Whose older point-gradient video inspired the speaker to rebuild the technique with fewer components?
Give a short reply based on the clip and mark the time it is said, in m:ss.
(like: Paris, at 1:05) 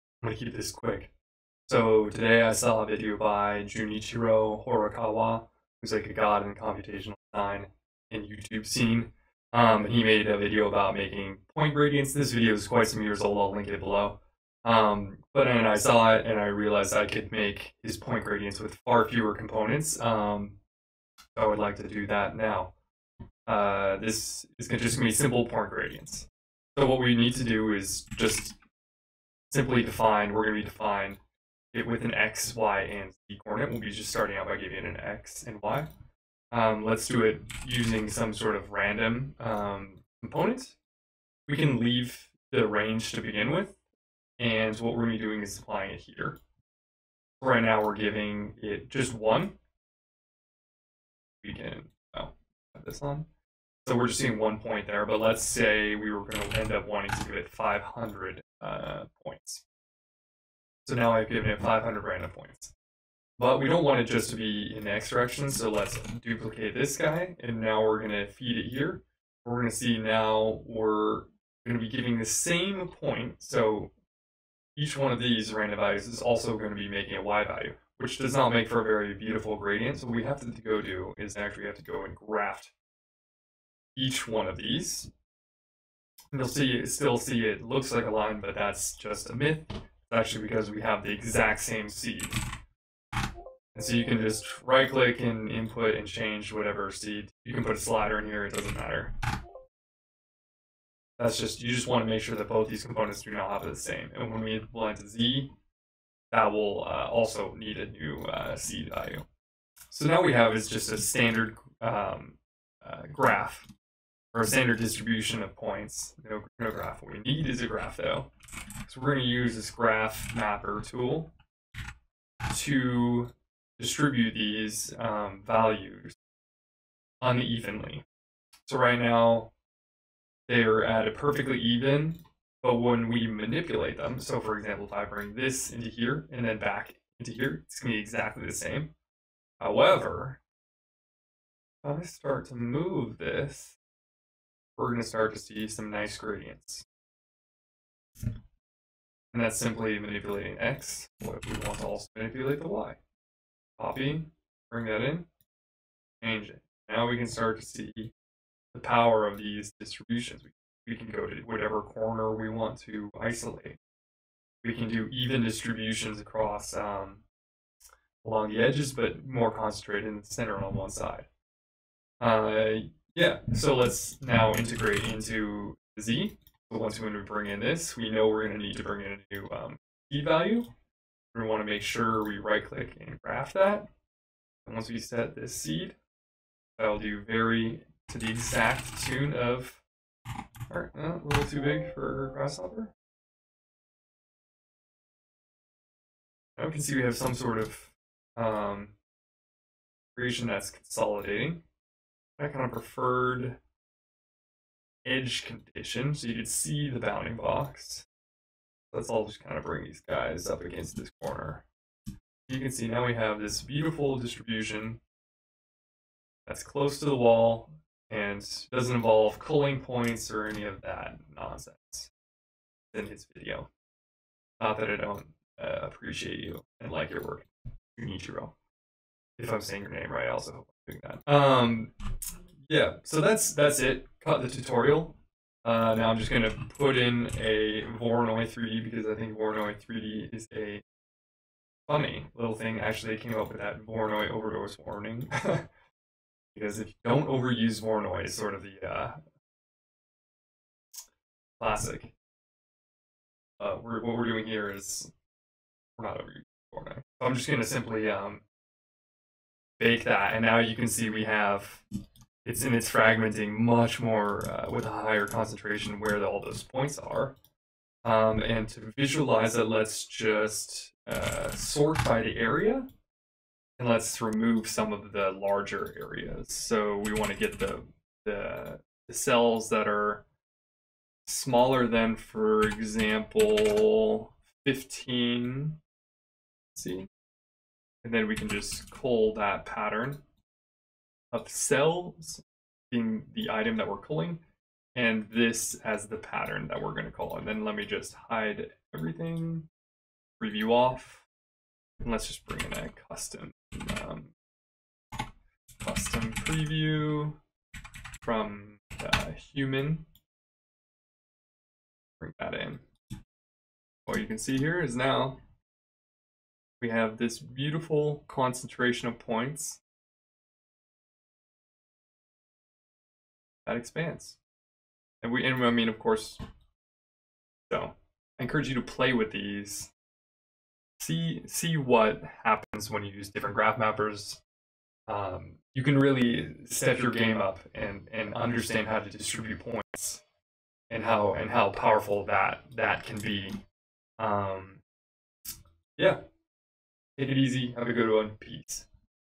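Junichiro Horikawa, at 0:03.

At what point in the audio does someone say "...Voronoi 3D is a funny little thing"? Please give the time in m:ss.
3:59.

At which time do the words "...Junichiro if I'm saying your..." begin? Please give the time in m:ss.
3:47.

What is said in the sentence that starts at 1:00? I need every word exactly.
So now I've given it 500 random points.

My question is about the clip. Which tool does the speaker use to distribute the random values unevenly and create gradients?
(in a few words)
graph mapper.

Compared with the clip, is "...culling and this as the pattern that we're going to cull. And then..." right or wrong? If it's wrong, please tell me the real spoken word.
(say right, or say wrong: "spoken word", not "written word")
right.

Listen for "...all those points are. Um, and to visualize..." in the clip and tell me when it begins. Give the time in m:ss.
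4:26.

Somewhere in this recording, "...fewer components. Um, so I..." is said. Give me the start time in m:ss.
0:19.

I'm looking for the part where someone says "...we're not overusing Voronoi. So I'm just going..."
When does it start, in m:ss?
4:15.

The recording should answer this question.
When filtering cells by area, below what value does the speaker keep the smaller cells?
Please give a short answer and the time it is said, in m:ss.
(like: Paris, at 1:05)
15, at 4:44.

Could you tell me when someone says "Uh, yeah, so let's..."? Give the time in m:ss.
2:52.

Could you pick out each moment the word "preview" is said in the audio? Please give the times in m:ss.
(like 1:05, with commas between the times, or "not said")
5:00, 5:06.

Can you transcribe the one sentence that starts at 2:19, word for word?
However, if I start to move this, we're going to start to see some nice gradients.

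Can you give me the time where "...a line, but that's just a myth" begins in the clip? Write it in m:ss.
1:28.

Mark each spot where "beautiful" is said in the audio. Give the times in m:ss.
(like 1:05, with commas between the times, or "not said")
1:19, 3:33, 5:17.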